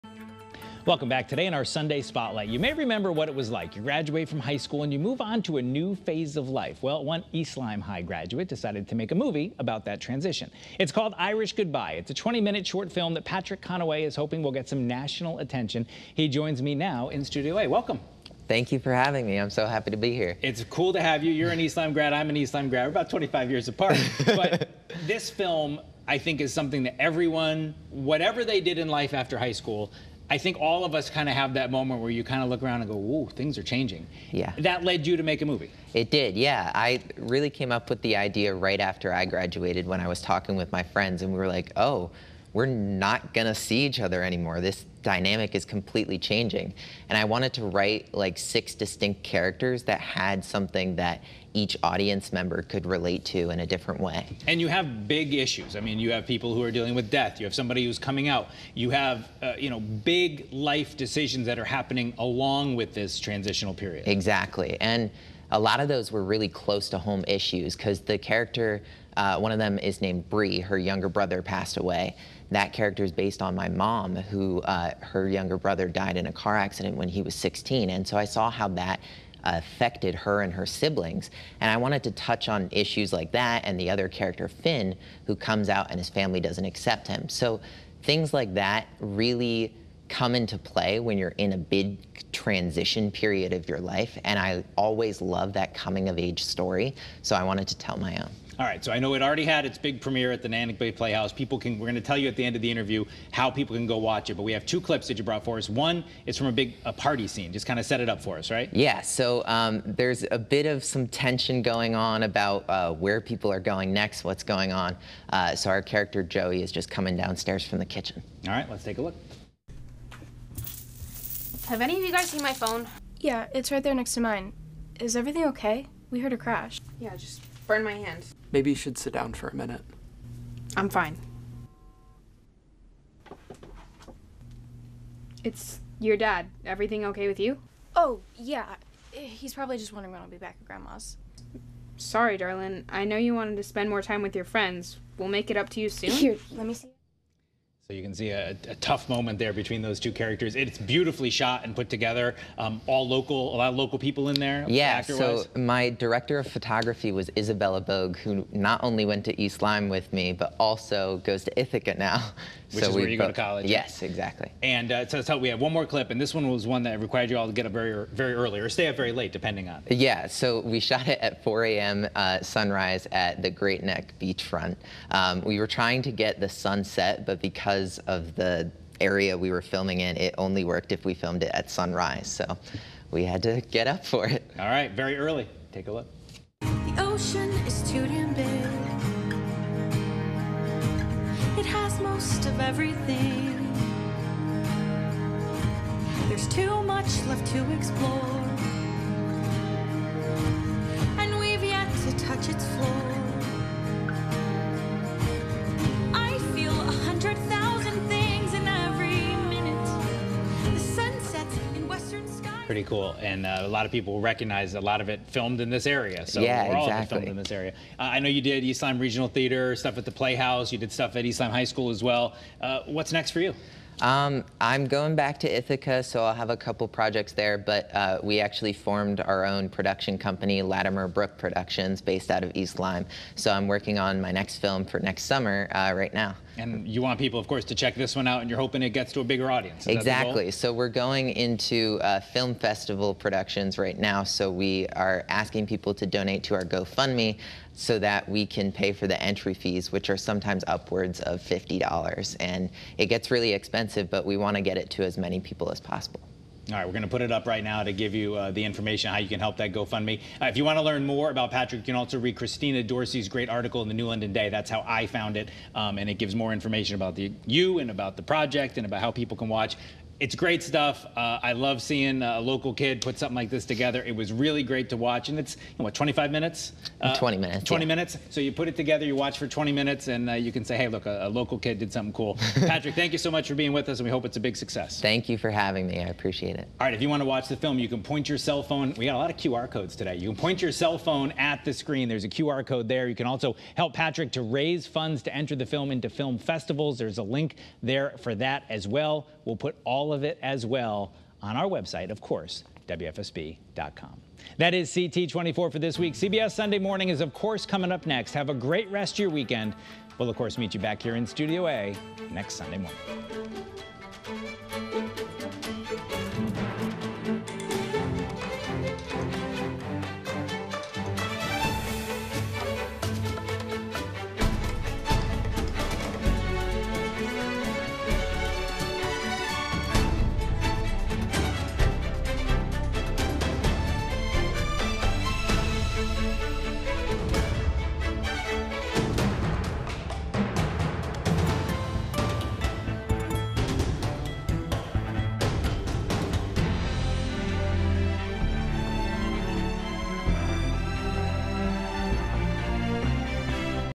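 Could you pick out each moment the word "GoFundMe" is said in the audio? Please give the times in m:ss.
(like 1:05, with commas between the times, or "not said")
4:06, 4:19.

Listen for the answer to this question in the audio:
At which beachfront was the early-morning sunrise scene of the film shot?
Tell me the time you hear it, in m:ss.
2:53.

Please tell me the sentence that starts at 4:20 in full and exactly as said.
Uh, if you want to learn more about Patrick, you can also read Christina Dorsey's great article in the New London Day.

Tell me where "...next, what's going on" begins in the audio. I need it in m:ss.
1:53.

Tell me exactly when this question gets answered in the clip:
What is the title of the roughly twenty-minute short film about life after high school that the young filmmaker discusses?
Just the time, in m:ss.
0:11.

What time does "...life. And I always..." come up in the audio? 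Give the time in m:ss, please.
1:33.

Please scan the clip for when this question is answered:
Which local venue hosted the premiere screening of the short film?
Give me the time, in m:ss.
1:40.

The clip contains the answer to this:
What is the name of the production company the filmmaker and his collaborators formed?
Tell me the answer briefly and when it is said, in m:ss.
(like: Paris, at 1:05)
Latimer Brook Productions, at 3:50.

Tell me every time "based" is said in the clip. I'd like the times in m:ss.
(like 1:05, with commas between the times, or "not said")
1:13, 3:52.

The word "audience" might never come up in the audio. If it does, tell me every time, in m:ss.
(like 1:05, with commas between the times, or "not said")
0:51, 3:59.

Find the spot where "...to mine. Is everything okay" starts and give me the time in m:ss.
2:04.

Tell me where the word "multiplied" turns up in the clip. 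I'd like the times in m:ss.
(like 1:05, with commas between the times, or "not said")
not said.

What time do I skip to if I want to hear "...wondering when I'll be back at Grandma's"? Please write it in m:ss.
2:19.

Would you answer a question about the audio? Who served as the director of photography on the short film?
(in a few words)
Isabella Bogue.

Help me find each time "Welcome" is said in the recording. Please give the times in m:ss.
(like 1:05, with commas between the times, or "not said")
0:00, 0:17.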